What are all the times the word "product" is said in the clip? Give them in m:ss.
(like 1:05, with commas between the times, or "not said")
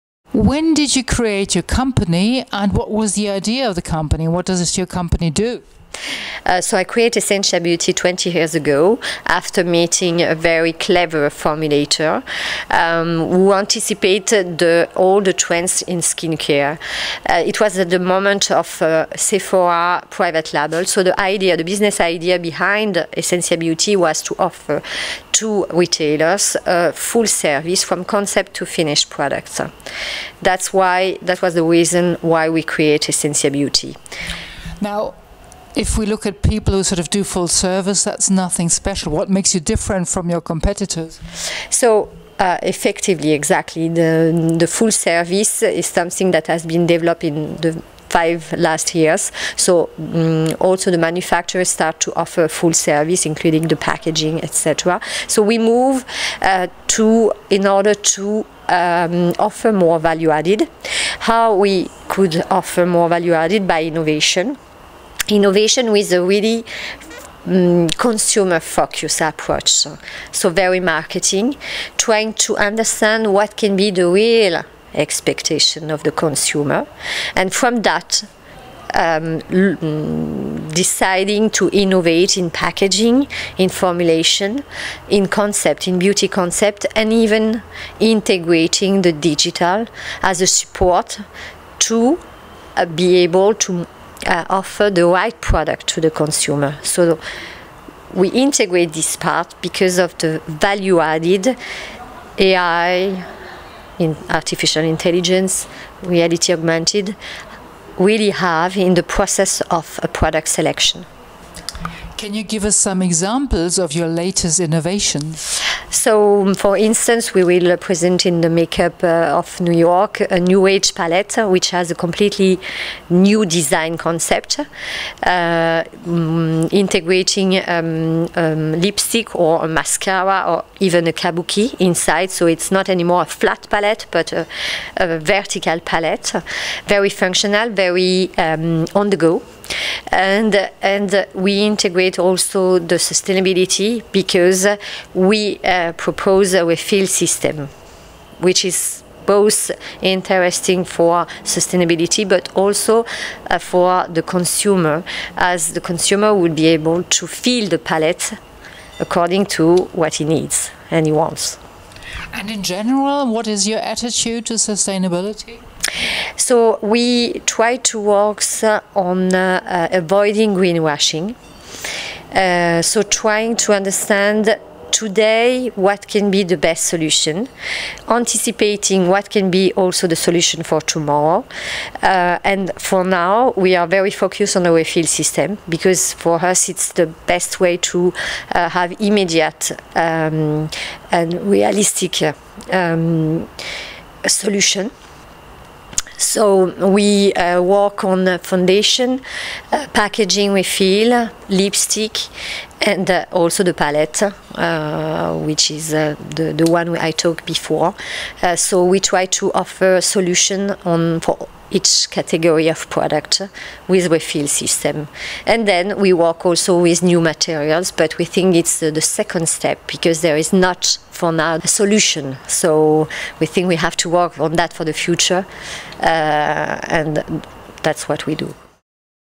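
0:29, 1:35, 1:50, 3:32.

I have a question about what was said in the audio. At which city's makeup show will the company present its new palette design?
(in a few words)
New York.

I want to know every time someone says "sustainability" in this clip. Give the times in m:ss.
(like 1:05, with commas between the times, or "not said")
2:22, 2:31, 2:44.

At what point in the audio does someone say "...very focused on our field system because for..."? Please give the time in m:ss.
3:03.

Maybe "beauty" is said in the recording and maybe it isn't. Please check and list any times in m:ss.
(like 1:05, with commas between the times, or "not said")
0:07, 0:23, 0:33, 1:25.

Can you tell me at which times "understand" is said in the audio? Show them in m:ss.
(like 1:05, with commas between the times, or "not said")
1:12, 2:53.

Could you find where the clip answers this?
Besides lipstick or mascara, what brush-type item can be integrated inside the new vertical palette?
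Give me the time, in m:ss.
2:11.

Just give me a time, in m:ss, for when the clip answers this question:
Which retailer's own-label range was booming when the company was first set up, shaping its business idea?
0:19.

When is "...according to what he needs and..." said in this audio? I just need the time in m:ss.
2:38.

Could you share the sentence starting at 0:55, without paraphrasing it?
So we move uh, to in order to um, offer more value added.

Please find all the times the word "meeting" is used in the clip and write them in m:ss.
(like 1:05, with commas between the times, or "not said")
0:09.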